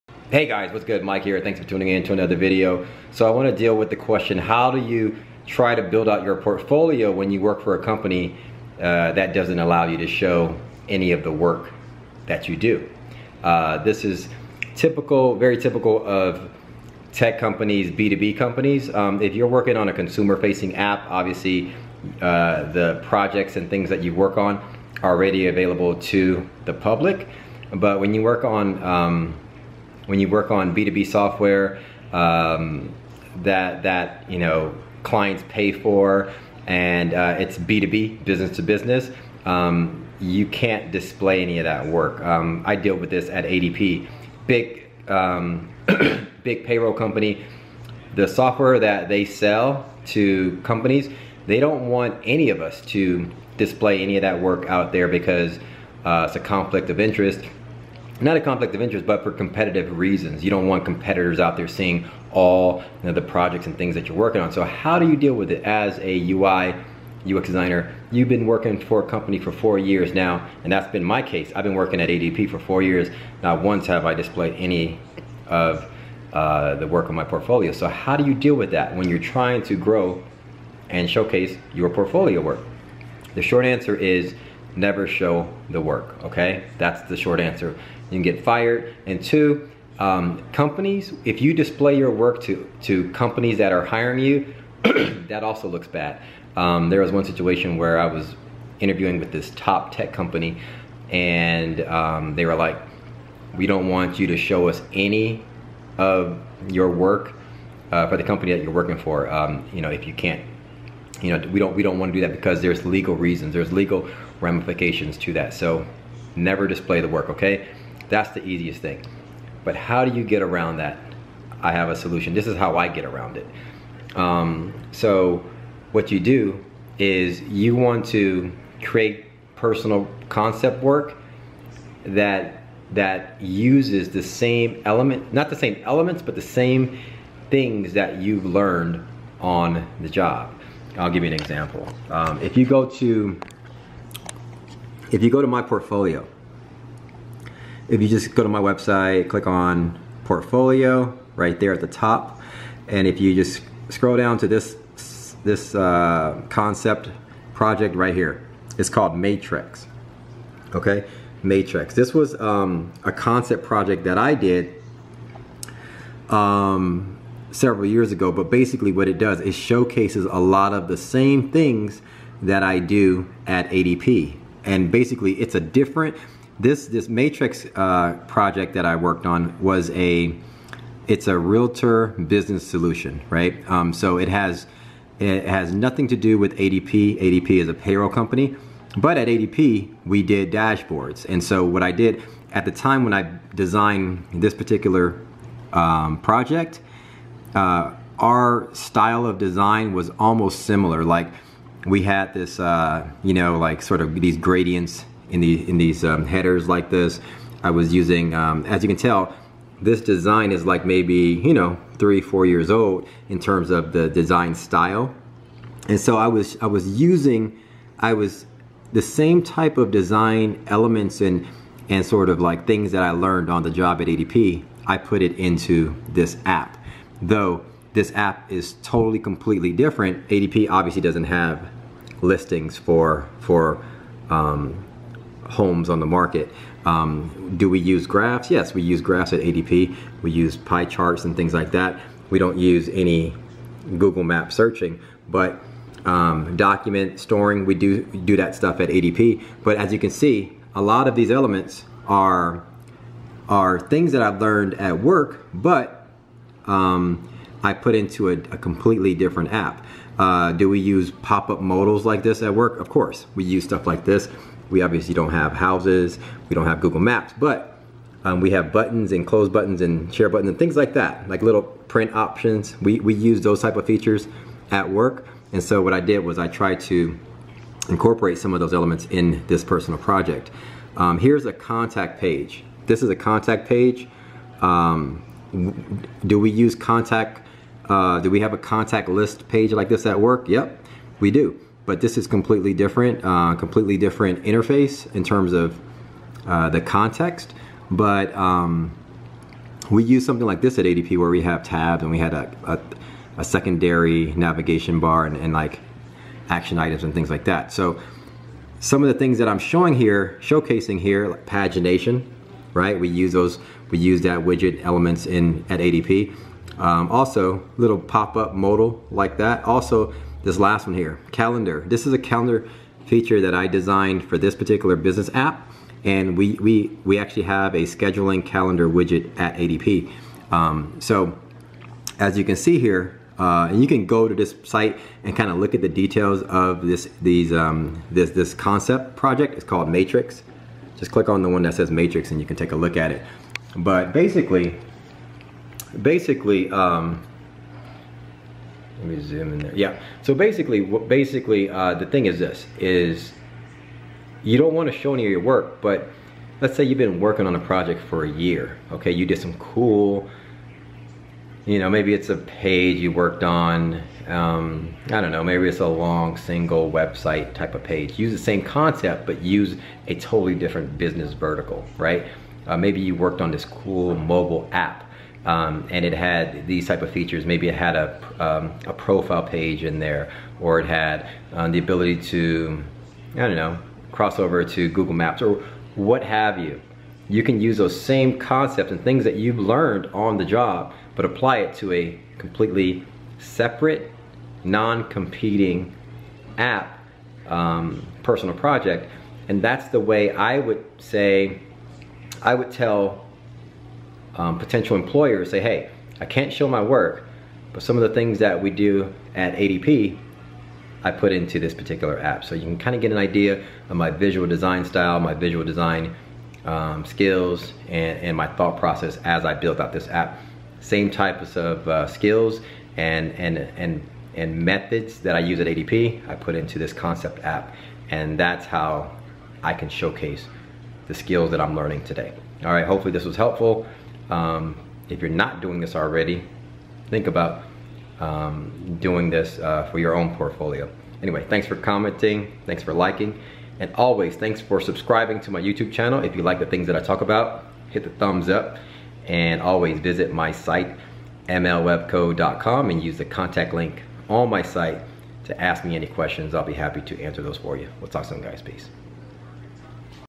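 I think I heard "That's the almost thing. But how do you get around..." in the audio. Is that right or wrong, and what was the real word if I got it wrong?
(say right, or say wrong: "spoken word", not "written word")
wrong: "easiest", not "almost".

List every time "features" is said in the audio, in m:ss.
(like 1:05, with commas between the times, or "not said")
4:33, 5:23, 6:17.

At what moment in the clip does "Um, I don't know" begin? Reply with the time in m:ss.
6:04.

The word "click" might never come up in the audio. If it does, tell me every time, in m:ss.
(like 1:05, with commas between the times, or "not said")
2:29, 5:41.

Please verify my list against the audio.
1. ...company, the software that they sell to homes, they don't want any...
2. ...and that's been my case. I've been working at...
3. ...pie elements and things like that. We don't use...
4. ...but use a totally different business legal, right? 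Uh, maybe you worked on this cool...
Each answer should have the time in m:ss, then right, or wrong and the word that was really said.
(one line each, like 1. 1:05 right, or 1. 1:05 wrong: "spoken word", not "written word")
1. 0:46 wrong: "companies", not "homes"
2. 1:10 right
3. 4:00 wrong: "charts", not "elements"
4. 6:09 wrong: "vertical", not "legal".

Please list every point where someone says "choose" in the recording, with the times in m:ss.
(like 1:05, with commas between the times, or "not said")
not said.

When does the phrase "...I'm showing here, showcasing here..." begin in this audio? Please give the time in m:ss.
5:09.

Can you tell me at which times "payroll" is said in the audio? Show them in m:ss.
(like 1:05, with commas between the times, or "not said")
0:46, 3:07.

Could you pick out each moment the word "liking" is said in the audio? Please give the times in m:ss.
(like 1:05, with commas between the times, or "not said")
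7:22.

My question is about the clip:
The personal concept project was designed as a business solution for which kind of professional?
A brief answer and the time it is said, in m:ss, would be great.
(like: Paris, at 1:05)
Realtor, at 3:01.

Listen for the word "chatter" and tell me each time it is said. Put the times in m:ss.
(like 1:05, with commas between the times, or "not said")
not said.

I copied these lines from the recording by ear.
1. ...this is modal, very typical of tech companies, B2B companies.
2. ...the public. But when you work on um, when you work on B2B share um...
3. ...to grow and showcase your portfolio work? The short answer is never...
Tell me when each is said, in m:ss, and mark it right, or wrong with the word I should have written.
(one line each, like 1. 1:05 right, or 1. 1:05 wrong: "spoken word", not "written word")
1. 0:13 wrong: "typical", not "modal"
2. 0:26 wrong: "software", not "share"
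3. 1:19 right.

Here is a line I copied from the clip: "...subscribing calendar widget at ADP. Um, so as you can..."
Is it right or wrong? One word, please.
wrong.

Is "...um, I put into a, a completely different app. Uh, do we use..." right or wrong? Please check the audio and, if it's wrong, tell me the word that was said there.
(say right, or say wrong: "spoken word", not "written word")
right.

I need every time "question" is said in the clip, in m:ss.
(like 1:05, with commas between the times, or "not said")
0:03, 7:36.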